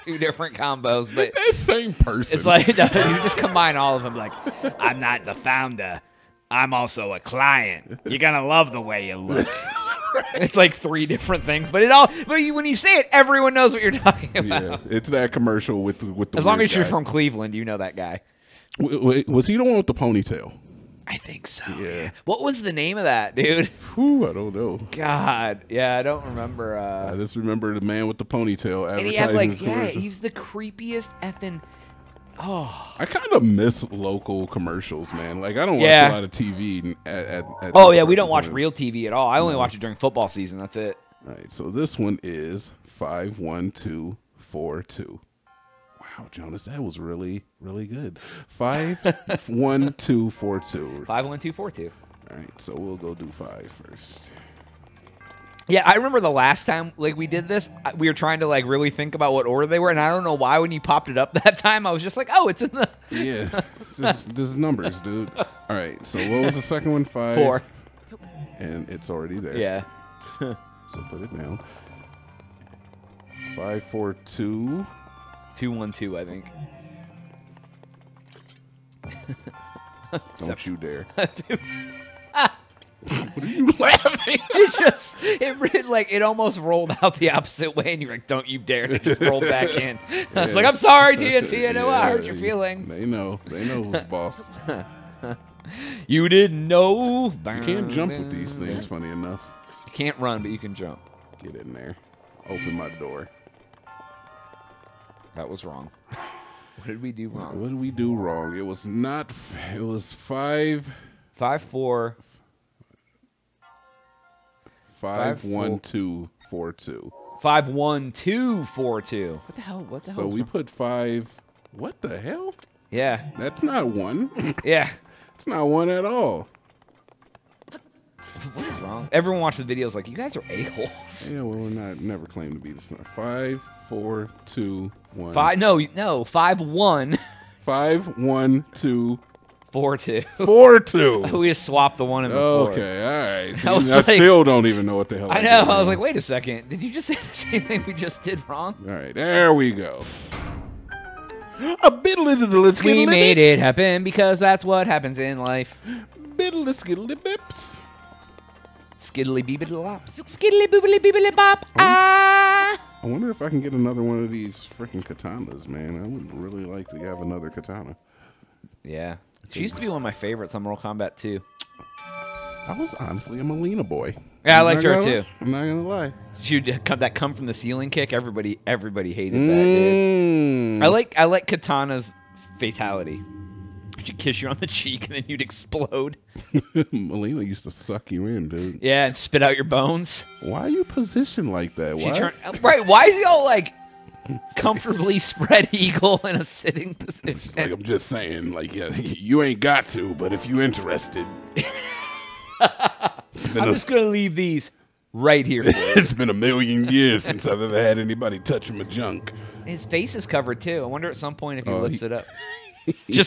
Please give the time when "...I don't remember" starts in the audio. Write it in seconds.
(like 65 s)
25 s.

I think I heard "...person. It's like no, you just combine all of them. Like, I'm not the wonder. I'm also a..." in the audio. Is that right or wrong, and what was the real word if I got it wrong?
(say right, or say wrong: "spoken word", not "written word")
wrong: "founder", not "wonder".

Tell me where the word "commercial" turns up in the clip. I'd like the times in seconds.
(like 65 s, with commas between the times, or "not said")
15 s, 34 s.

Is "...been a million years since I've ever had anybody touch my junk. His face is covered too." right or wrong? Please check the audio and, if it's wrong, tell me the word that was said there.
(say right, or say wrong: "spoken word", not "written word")
right.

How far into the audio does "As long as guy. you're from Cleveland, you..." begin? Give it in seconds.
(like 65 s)
16 s.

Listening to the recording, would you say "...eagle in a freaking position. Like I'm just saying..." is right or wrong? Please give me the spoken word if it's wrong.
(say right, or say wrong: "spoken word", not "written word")
wrong: "sitting", not "freaking".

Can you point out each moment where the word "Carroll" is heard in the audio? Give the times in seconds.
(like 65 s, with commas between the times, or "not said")
not said.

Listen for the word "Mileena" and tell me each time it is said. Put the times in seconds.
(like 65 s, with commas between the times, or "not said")
173 s, 186 s.